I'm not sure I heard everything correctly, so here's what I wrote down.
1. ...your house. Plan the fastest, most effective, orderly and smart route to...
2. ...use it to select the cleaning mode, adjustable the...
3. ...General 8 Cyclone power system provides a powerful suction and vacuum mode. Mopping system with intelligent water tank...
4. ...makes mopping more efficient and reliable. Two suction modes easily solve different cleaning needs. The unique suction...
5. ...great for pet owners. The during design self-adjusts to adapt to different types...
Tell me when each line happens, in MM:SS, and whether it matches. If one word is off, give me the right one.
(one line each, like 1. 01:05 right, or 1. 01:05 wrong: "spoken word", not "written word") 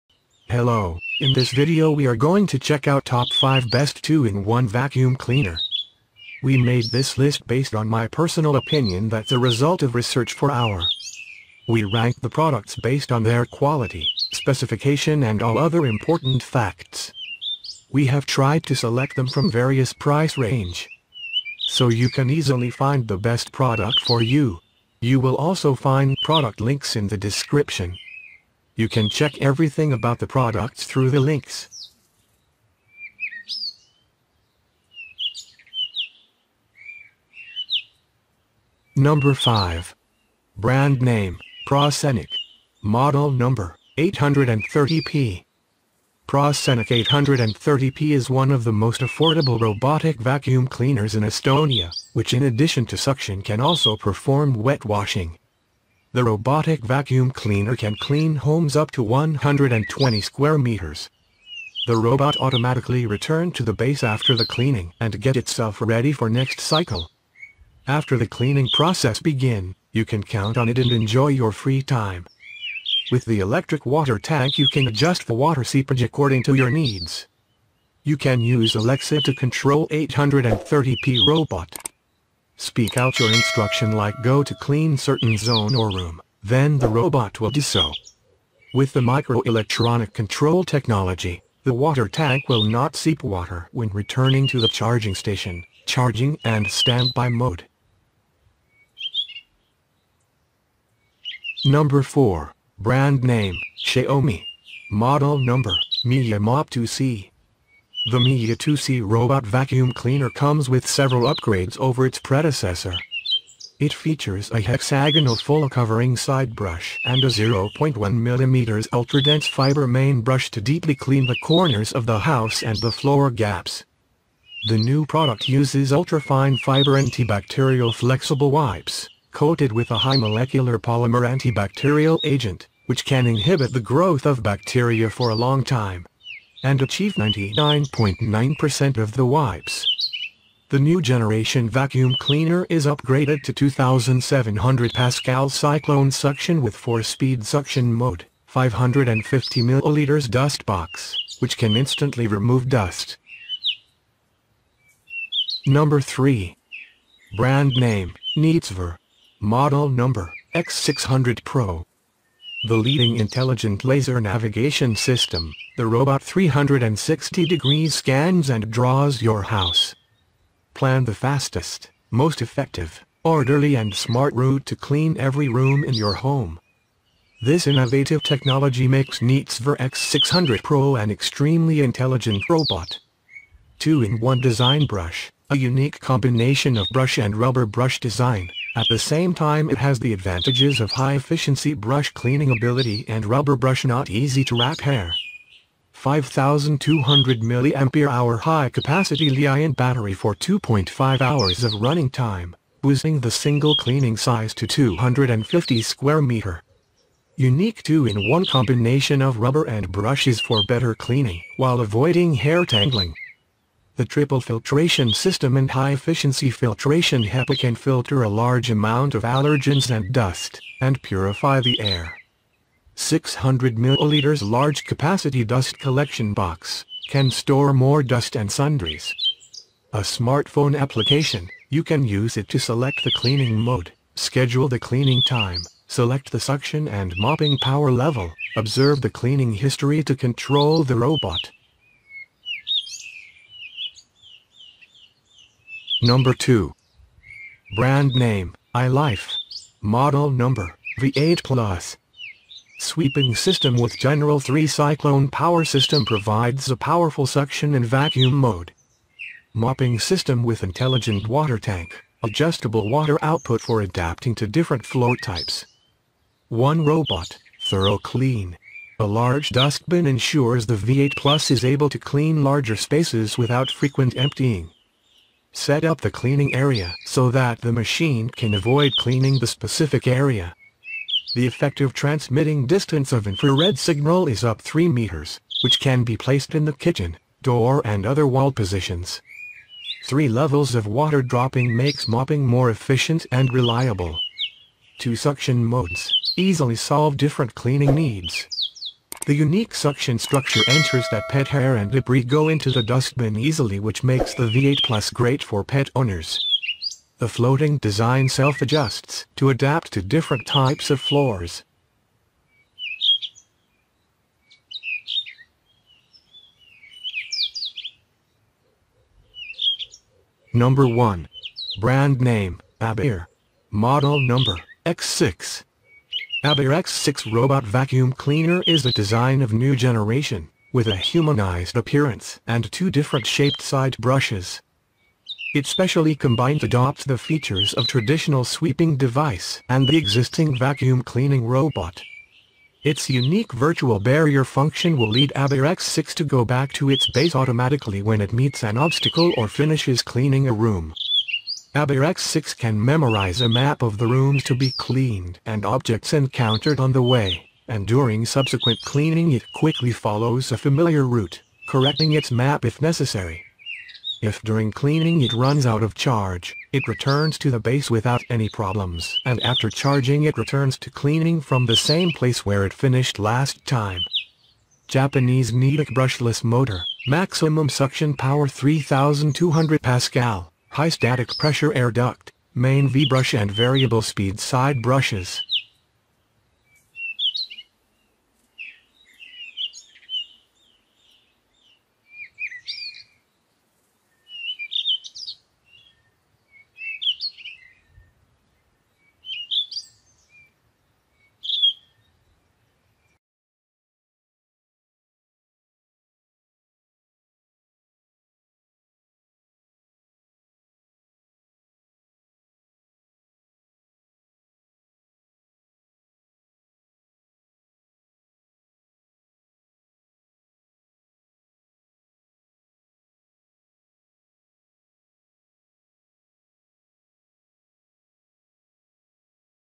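1. 02:49 right
2. 03:52 wrong: "schedule", not "adjustable"
3. 04:13 wrong: "3", not "8"
4. 04:51 right
5. 05:05 wrong: "floating", not "during".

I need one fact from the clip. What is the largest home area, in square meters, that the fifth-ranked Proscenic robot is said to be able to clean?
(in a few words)
120 square meters.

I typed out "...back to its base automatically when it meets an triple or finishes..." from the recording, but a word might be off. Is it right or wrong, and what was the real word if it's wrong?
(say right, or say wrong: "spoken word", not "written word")
wrong: "obstacle", not "triple".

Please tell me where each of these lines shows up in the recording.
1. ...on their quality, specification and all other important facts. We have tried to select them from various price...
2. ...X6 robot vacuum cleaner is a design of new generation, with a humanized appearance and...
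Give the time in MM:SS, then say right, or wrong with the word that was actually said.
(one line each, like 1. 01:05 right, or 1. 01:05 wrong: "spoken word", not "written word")
1. 00:13 right
2. 05:26 right.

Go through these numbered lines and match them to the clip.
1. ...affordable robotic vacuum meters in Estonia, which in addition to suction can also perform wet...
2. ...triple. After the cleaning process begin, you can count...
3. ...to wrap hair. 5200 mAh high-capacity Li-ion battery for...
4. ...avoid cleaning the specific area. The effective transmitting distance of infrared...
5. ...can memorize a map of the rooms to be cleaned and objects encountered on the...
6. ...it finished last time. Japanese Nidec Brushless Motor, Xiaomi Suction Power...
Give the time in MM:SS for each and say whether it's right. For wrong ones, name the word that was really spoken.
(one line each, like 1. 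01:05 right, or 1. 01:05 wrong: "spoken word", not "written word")
1. 00:49 wrong: "cleaners", not "meters"
2. 01:06 wrong: "cycle", not "triple"
3. 03:14 right
4. 04:38 right
5. 05:52 right
6. 06:12 wrong: "Maximum", not "Xiaomi".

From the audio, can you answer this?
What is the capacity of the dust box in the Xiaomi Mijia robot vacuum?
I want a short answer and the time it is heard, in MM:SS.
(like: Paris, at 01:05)
550 milliliters, at 02:28.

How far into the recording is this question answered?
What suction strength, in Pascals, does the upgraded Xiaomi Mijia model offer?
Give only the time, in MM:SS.
02:23.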